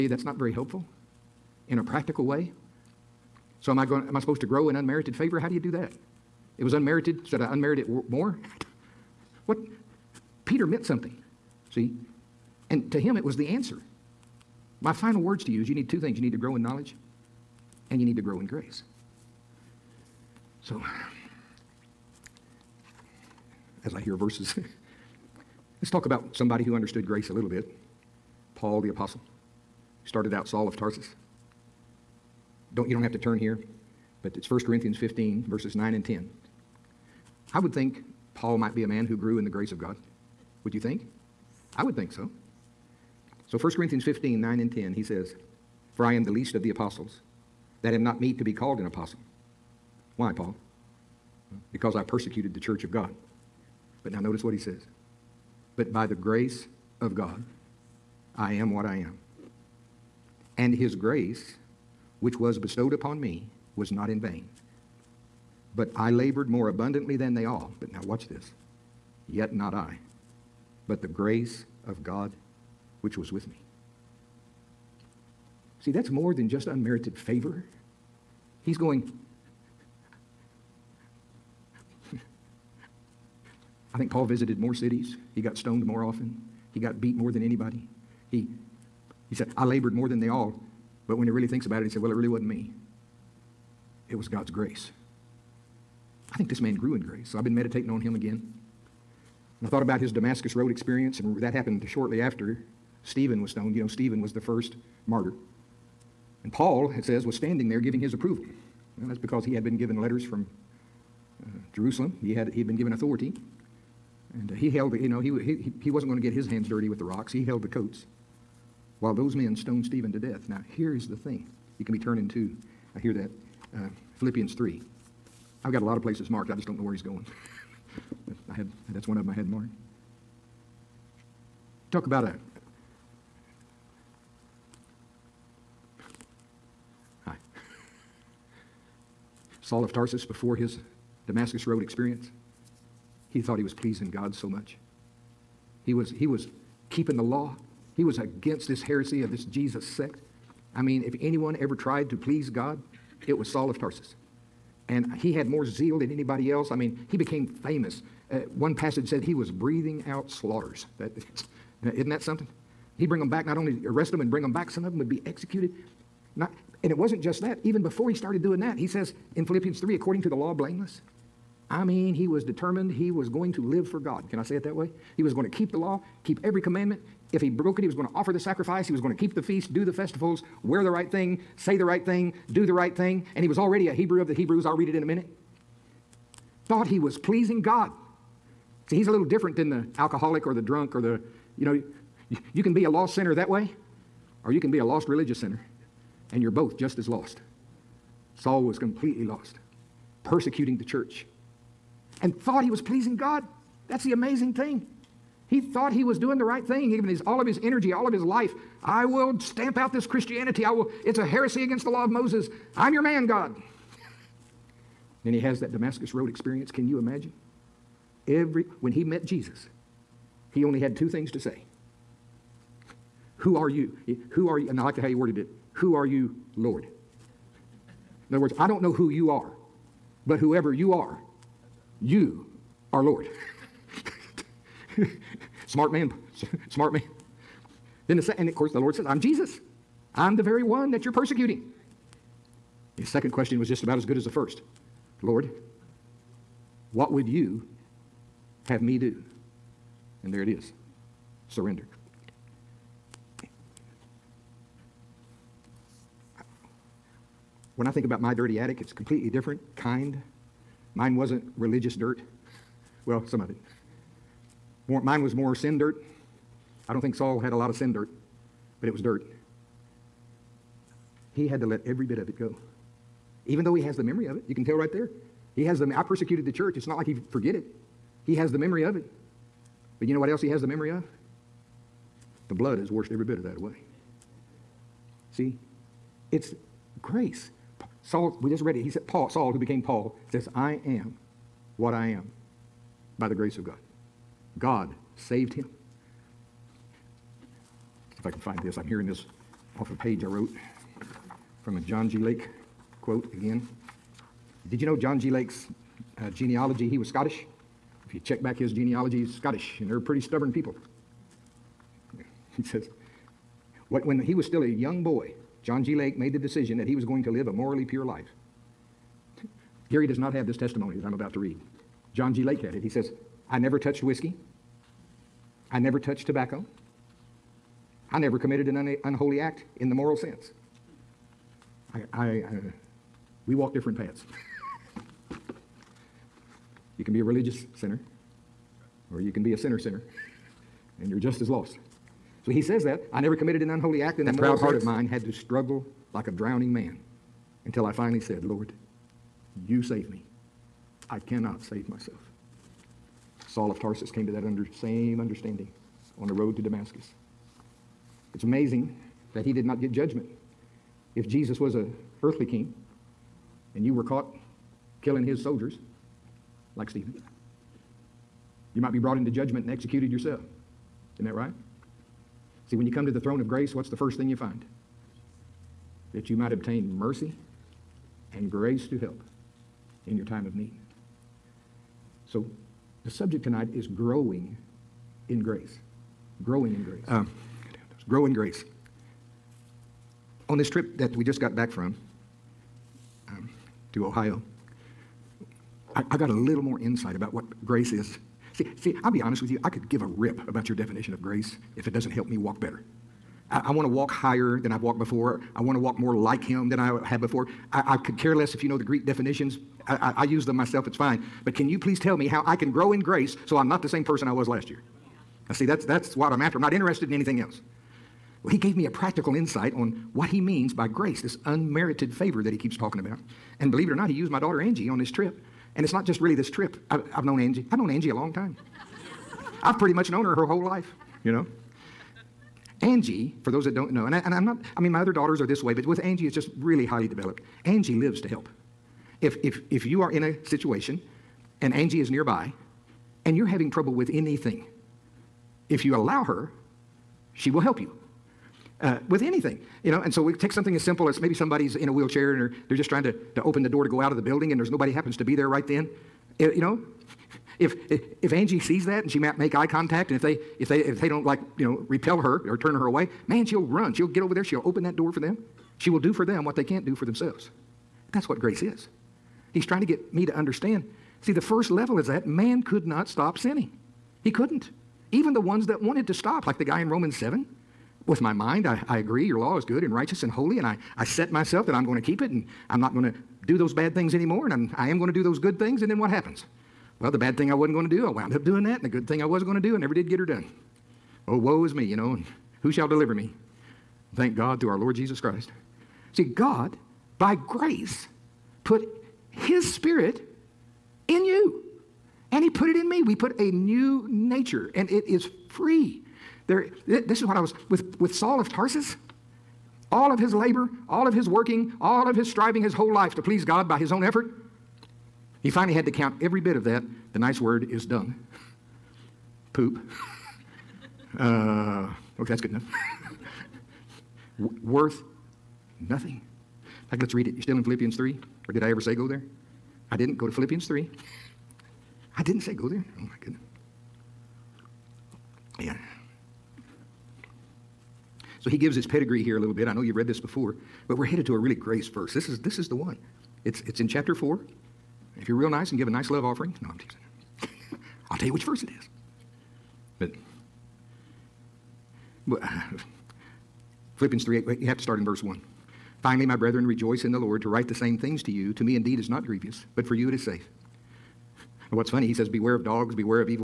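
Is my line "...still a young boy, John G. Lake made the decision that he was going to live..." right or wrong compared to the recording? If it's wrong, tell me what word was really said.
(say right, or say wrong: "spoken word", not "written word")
right.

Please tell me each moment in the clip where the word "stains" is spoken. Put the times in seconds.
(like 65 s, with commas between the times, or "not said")
not said.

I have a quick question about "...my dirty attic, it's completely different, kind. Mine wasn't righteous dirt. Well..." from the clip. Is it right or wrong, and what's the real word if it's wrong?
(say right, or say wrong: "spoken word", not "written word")
wrong: "religious", not "righteous".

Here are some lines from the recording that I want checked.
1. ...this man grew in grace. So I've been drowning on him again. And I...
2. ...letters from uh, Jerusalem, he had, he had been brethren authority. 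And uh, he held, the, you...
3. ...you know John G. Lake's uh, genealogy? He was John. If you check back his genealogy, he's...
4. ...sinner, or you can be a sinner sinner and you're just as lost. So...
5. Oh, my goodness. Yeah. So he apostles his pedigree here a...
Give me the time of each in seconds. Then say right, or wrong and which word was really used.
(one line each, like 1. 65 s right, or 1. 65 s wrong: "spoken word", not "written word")
1. 96 s wrong: "meditating", not "drowning"
2. 109 s wrong: "given", not "brethren"
3. 304 s wrong: "Scottish", not "John"
4. 337 s right
5. 532 s wrong: "gives", not "apostles".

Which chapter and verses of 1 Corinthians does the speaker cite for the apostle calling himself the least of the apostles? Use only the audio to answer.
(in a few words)
15, verses 9 and 10.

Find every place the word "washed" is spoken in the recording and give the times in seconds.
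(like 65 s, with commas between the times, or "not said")
282 s.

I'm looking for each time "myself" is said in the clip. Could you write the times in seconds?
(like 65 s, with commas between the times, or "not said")
351 s, 410 s, 481 s.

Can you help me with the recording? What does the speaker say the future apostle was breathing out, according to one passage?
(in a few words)
Slaughters.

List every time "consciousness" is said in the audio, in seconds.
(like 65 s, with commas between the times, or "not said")
not said.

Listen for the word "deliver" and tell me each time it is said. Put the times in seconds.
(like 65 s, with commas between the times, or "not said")
492 s.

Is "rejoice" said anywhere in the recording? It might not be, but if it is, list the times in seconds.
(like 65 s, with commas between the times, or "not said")
556 s.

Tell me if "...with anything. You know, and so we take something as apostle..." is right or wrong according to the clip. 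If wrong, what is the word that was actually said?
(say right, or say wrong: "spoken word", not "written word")
wrong: "simple", not "apostle".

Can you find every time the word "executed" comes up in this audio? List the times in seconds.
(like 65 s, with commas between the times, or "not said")
165 s, 369 s.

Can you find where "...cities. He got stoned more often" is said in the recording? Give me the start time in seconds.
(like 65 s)
84 s.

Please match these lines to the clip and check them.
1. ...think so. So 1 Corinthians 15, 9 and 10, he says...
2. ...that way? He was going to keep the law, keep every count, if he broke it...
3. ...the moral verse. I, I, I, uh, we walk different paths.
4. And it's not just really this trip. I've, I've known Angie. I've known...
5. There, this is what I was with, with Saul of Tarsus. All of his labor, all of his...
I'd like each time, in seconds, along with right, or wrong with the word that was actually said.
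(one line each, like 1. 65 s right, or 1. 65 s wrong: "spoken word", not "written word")
1. 41 s right
2. 174 s wrong: "commandment", not "count"
3. 329 s wrong: "sense", not "verse"
4. 425 s right
5. 506 s right.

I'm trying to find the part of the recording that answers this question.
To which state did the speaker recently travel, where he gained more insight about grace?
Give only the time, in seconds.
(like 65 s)
394 s.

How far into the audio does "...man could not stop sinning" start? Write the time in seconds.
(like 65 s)
472 s.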